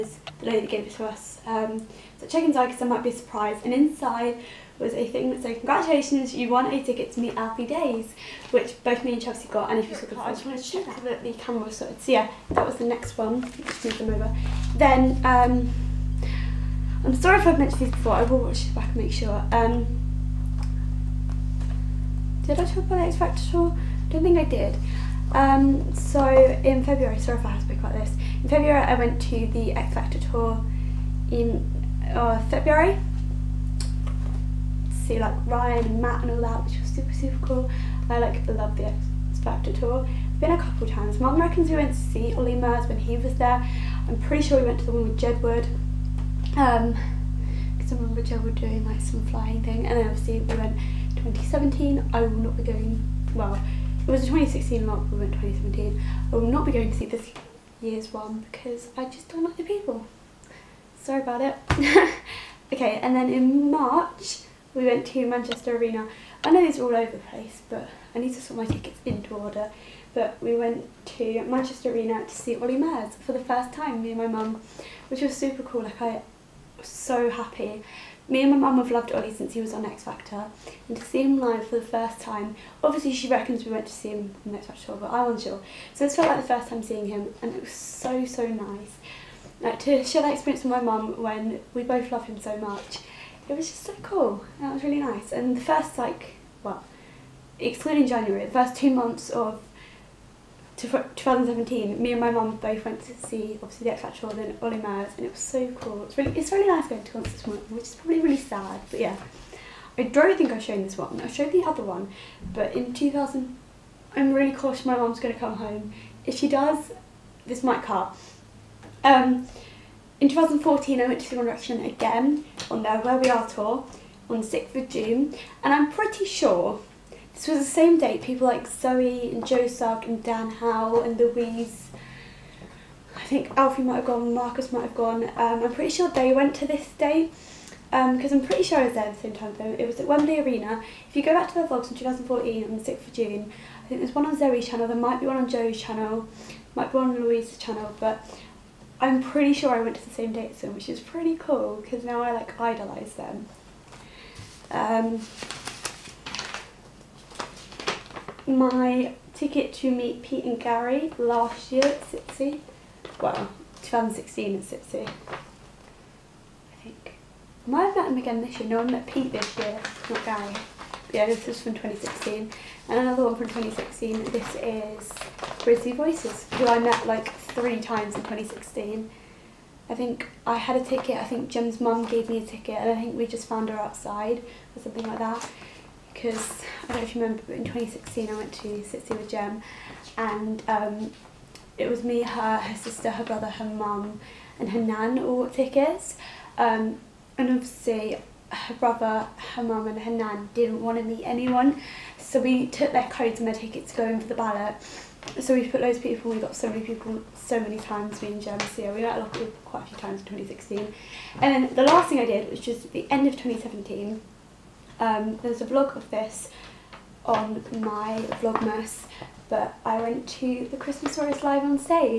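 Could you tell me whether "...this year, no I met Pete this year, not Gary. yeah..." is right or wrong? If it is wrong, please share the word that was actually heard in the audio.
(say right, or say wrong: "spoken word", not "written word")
right.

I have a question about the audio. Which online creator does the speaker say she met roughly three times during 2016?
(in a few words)
Brizzy Voices.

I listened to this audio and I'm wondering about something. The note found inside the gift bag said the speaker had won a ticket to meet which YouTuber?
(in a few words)
Alfie Deyes.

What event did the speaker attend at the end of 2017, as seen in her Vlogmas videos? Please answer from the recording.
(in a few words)
Christmasaurus Live.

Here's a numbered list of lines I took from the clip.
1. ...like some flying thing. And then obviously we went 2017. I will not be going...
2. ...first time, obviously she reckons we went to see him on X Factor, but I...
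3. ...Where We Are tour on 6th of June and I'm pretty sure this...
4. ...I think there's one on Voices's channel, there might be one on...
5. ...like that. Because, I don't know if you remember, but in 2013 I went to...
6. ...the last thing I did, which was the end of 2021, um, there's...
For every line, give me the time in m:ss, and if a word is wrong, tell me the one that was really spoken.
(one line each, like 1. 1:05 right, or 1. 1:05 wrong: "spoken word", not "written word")
1. 0:48 right
2. 1:21 right
3. 2:02 right
4. 2:23 wrong: "Zoe", not "Voices"
5. 3:05 wrong: "2016", not "2013"
6. 3:31 wrong: "2017", not "2021".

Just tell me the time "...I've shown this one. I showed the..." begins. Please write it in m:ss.
1:50.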